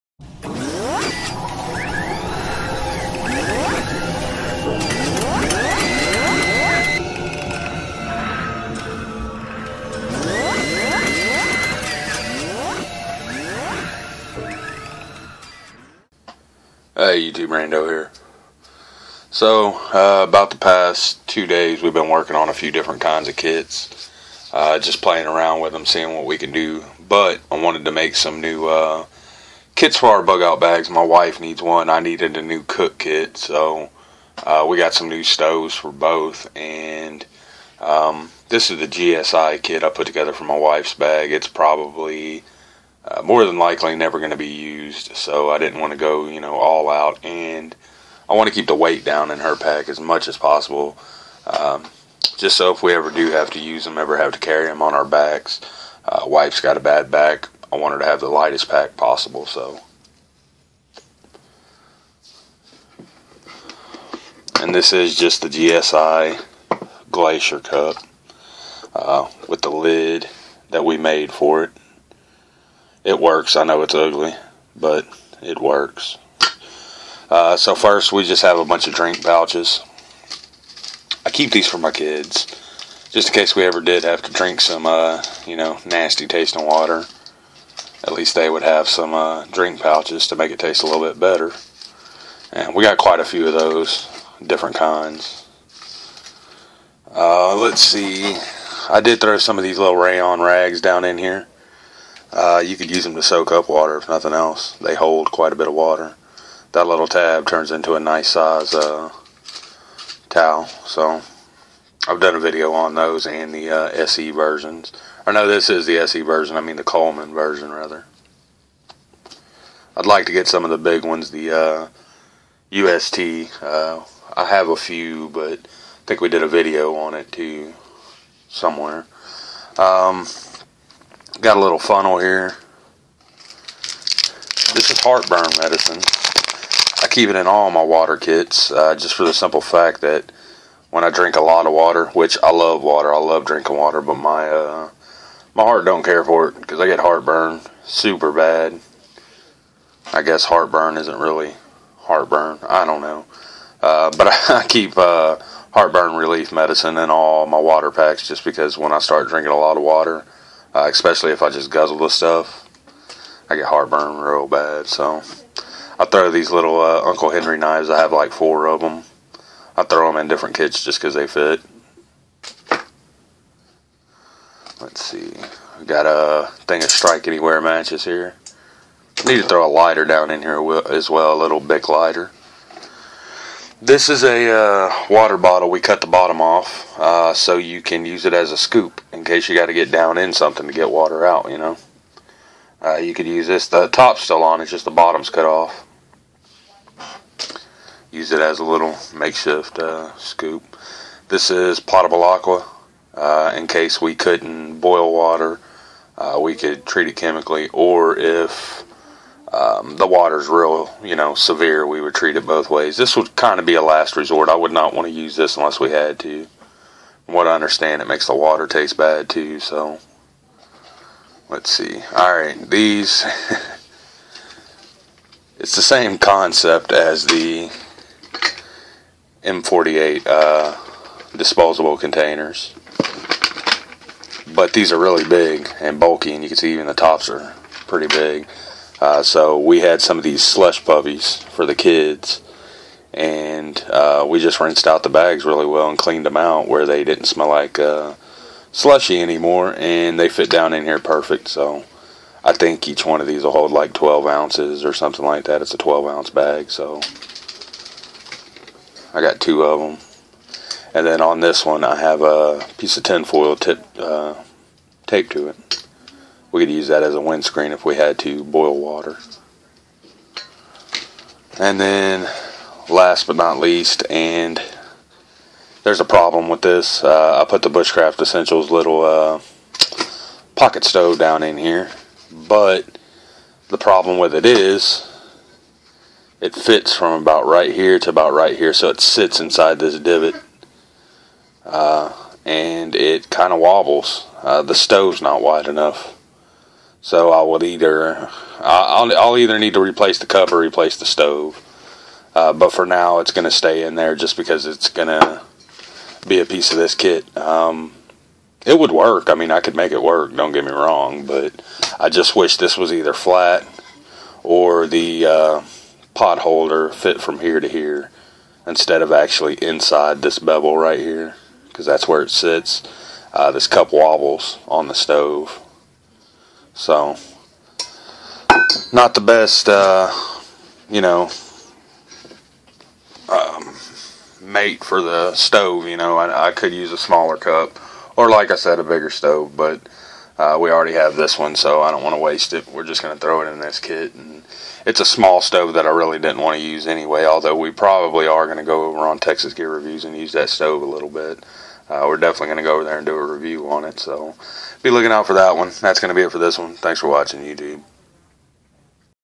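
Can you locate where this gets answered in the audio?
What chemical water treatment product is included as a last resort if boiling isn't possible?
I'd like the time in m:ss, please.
3:21.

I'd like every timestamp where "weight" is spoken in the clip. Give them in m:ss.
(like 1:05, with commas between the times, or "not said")
0:48.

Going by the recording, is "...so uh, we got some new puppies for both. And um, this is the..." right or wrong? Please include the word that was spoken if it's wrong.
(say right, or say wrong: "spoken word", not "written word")
wrong: "stoves", not "puppies".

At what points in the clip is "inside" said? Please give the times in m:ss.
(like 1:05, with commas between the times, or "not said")
4:49, 5:19.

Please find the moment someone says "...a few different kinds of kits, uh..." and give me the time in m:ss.
0:22.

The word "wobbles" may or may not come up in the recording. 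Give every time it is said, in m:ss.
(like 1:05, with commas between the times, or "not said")
4:53, 5:23.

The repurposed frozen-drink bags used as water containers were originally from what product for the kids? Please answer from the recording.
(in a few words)
slush puppies.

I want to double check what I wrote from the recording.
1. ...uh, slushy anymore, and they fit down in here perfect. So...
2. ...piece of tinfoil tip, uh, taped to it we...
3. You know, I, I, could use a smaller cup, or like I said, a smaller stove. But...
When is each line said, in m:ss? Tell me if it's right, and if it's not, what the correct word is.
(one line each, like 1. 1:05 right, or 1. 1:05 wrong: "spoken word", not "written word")
1. 4:07 right
2. 4:22 right
3. 5:35 wrong: "bigger", not "smaller".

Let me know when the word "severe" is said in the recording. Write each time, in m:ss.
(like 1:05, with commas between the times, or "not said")
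3:31.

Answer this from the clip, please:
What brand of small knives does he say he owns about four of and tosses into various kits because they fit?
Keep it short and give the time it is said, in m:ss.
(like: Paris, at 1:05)
Uncle Henry, at 2:47.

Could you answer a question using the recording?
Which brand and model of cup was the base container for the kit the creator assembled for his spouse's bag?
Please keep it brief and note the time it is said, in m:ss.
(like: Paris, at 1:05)
GSI Glacier Cup, at 1:05.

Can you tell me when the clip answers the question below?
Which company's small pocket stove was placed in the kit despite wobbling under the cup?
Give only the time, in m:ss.
4:37.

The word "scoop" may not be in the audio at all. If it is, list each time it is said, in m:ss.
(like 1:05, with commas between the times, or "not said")
3:08, 3:20.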